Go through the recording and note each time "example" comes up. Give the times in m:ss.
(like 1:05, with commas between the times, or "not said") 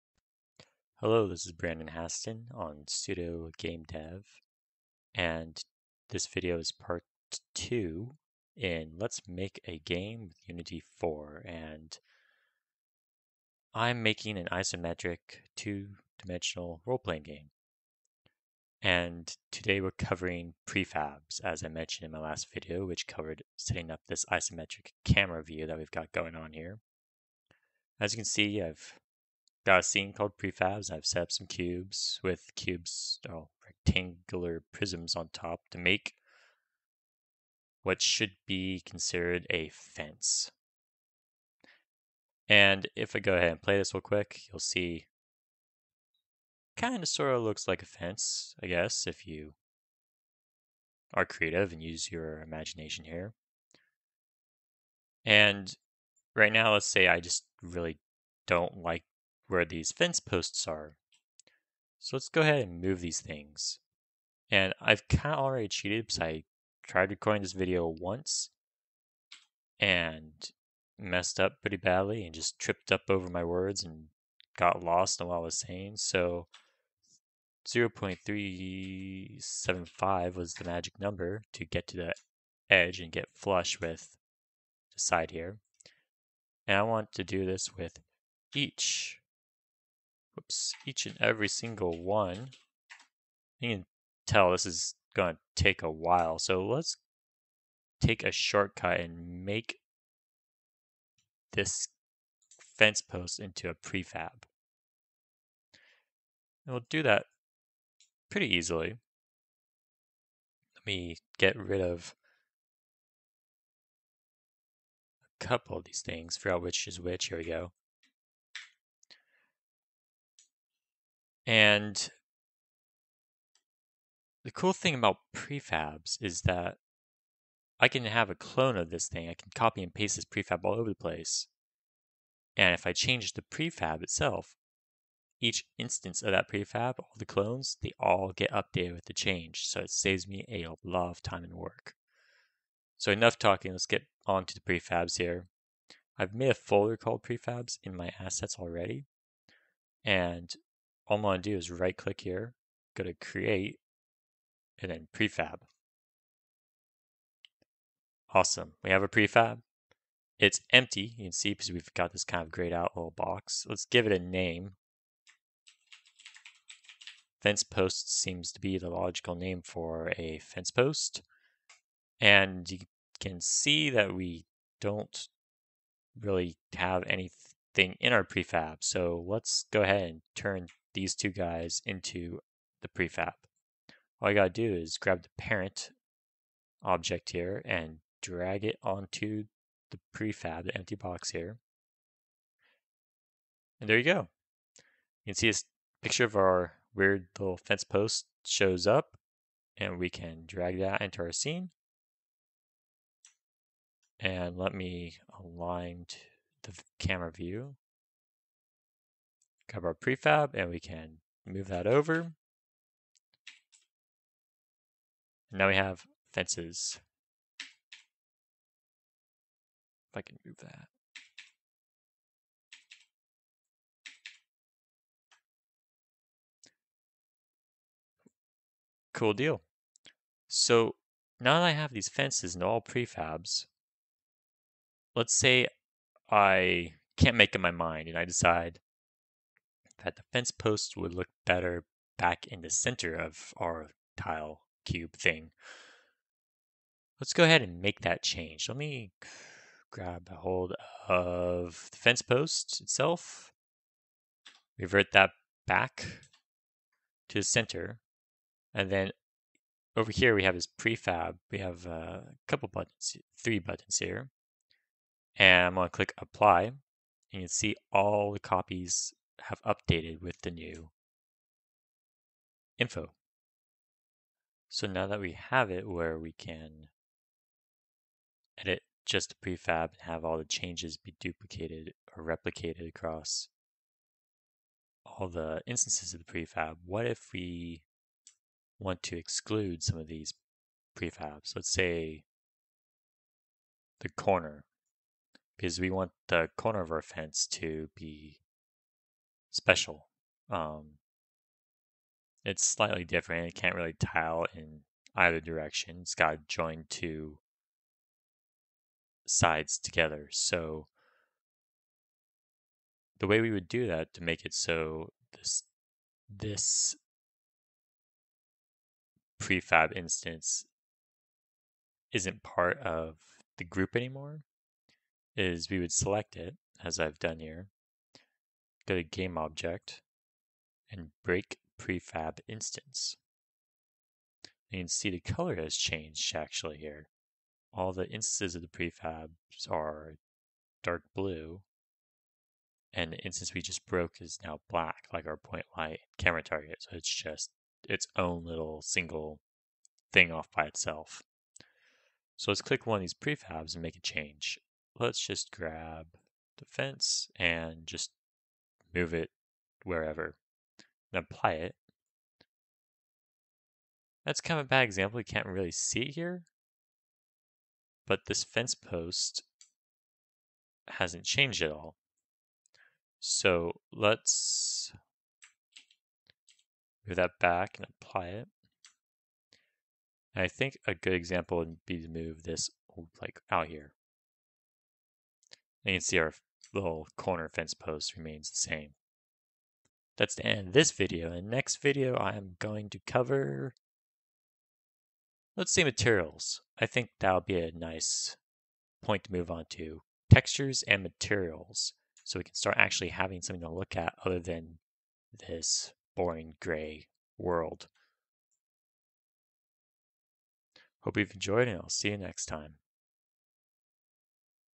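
6:04, 6:21.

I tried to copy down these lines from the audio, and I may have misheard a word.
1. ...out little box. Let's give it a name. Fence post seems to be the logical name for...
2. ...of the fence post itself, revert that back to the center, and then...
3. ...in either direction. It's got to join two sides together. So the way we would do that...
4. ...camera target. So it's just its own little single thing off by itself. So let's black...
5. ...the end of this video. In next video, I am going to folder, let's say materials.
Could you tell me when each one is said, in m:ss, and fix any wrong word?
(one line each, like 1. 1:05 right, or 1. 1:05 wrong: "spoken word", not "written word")
1. 2:42 right
2. 4:11 right
3. 5:04 right
4. 5:46 wrong: "click", not "black"
5. 6:30 wrong: "cover", not "folder".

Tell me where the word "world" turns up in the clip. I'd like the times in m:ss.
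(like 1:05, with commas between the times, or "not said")
6:47.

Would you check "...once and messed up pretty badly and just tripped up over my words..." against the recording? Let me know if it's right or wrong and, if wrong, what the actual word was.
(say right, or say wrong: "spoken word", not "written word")
right.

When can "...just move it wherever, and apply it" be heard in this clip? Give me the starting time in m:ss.
5:57.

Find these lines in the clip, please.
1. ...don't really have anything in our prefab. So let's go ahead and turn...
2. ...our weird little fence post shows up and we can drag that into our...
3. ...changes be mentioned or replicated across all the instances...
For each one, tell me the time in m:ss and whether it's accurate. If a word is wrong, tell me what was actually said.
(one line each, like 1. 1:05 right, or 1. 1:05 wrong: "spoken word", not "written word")
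1. 2:54 right
2. 3:16 right
3. 4:40 wrong: "duplicated", not "mentioned".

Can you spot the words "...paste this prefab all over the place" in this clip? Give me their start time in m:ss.
2:09.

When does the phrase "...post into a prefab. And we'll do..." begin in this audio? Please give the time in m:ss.
1:43.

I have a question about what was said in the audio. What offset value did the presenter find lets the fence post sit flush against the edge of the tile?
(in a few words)
0.375.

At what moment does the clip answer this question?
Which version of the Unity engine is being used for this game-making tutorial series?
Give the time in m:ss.
0:10.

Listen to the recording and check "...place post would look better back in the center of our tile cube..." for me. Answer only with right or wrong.
wrong.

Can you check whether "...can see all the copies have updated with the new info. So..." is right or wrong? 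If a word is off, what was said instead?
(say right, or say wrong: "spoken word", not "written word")
right.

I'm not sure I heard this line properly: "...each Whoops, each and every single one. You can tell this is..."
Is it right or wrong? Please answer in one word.
right.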